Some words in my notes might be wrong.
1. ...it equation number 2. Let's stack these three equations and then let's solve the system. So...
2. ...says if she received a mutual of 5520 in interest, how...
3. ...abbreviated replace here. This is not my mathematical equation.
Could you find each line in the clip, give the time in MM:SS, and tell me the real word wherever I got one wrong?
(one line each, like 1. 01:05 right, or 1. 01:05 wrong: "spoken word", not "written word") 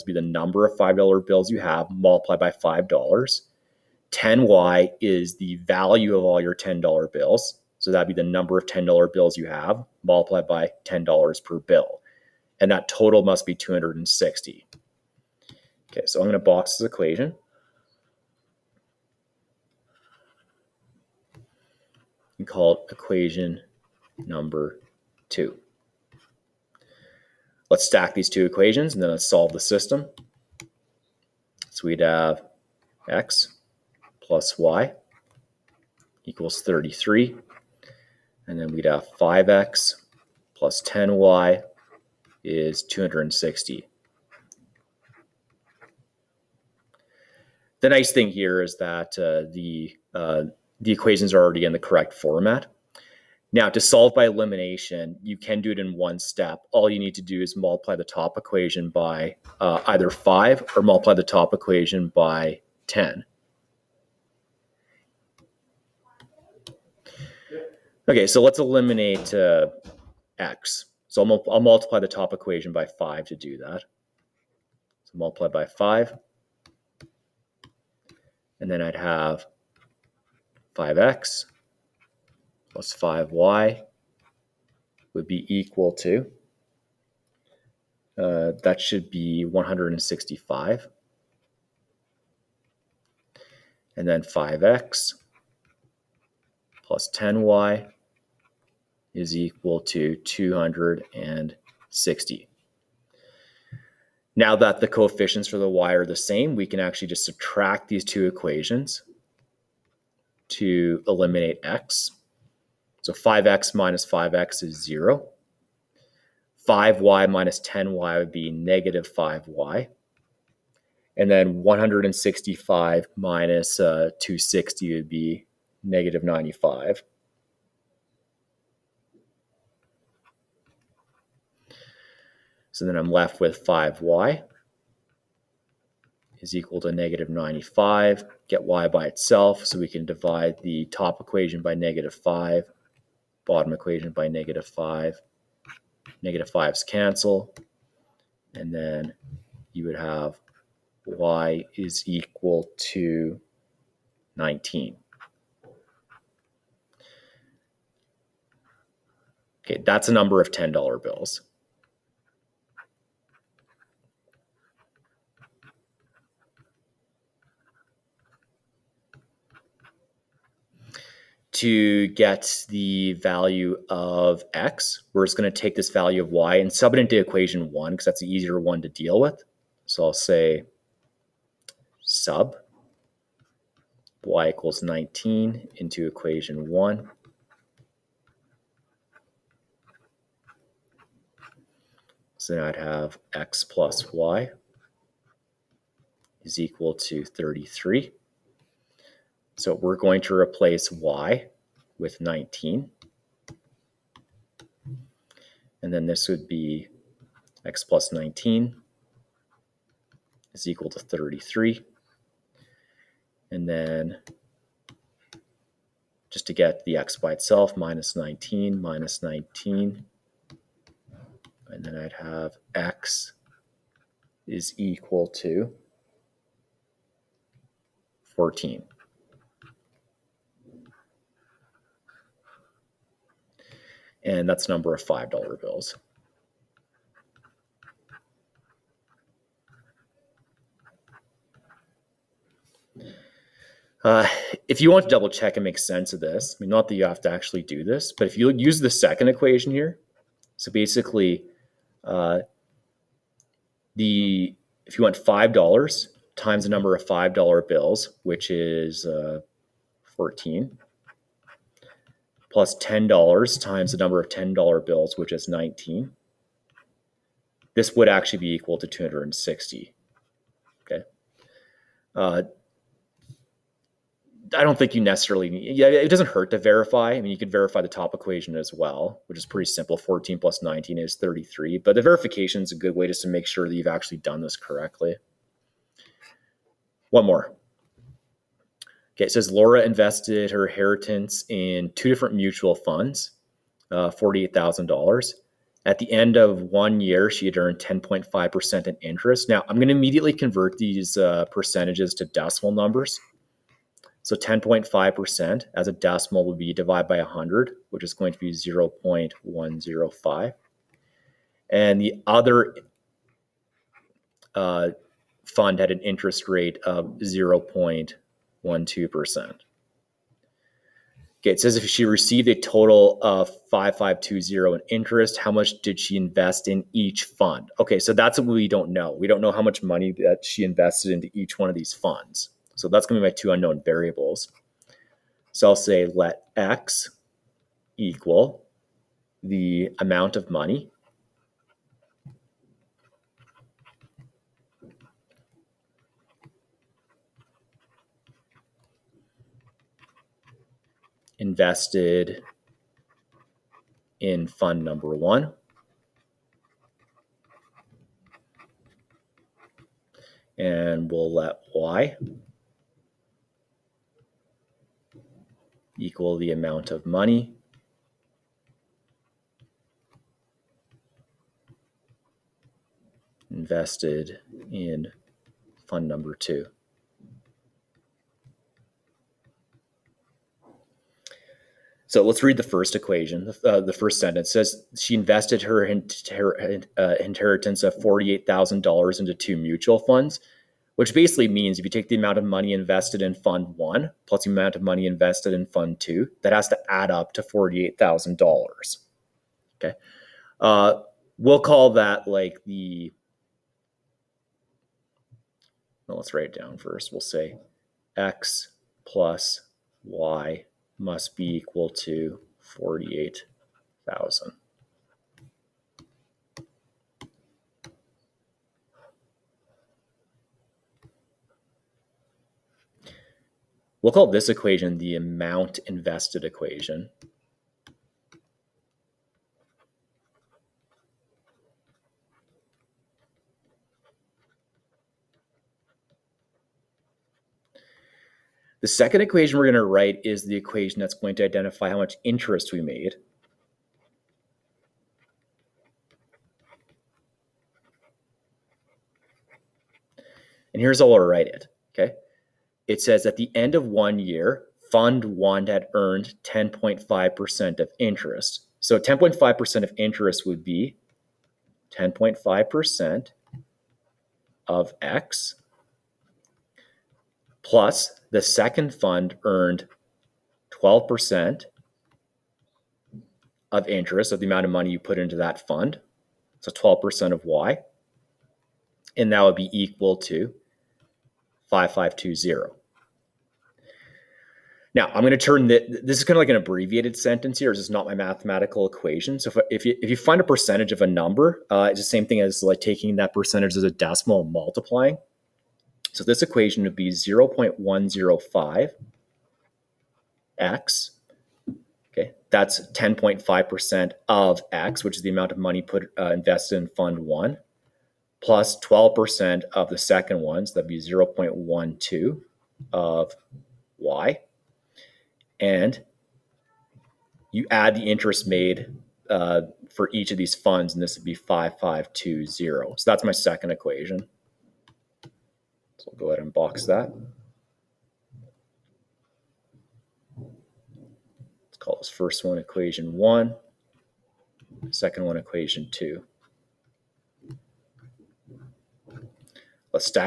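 1. 00:22 wrong: "two", not "three"
2. 05:21 wrong: "total", not "mutual"
3. 08:06 wrong: "sentence", not "replace".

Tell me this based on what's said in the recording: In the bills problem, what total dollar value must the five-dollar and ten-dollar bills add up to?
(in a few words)
$260.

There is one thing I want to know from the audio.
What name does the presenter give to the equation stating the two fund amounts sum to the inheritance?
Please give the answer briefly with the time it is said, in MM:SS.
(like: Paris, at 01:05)
amount invested equation, at 07:04.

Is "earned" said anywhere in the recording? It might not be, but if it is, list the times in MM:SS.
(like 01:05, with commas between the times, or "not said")
04:57, 07:35, 07:49.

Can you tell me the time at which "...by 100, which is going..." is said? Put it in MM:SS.
05:07.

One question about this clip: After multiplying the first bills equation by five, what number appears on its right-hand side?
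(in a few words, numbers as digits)
165.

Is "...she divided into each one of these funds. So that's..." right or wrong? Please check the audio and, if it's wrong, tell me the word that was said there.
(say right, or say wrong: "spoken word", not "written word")
wrong: "invested", not "divided".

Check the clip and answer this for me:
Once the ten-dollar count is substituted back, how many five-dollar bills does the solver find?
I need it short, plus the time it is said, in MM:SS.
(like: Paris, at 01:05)
14, at 03:42.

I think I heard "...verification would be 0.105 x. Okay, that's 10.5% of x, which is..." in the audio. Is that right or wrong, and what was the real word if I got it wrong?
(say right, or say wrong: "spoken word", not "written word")
wrong: "equation", not "verification".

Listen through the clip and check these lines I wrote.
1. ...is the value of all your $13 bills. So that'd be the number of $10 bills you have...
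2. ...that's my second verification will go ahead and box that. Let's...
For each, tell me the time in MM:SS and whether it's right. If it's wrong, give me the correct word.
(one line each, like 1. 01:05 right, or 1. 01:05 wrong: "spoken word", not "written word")
1. 00:05 wrong: "10", not "13"
2. 08:43 wrong: "equation", not "verification".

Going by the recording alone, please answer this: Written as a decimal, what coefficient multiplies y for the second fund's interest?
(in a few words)
0.12.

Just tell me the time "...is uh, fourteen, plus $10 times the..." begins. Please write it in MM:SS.
04:18.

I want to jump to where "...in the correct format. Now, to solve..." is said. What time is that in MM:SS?
00:51.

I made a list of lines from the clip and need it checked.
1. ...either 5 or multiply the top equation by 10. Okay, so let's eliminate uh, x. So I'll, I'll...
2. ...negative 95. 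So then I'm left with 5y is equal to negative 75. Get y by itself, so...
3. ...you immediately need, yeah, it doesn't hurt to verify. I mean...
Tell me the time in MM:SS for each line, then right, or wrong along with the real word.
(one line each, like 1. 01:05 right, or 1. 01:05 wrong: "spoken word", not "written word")
1. 00:59 right
2. 02:05 wrong: "95", not "75"
3. 04:34 wrong: "necessarily", not "immediately".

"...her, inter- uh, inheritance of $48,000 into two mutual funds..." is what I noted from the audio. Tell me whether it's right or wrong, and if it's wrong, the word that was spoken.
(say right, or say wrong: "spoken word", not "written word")
right.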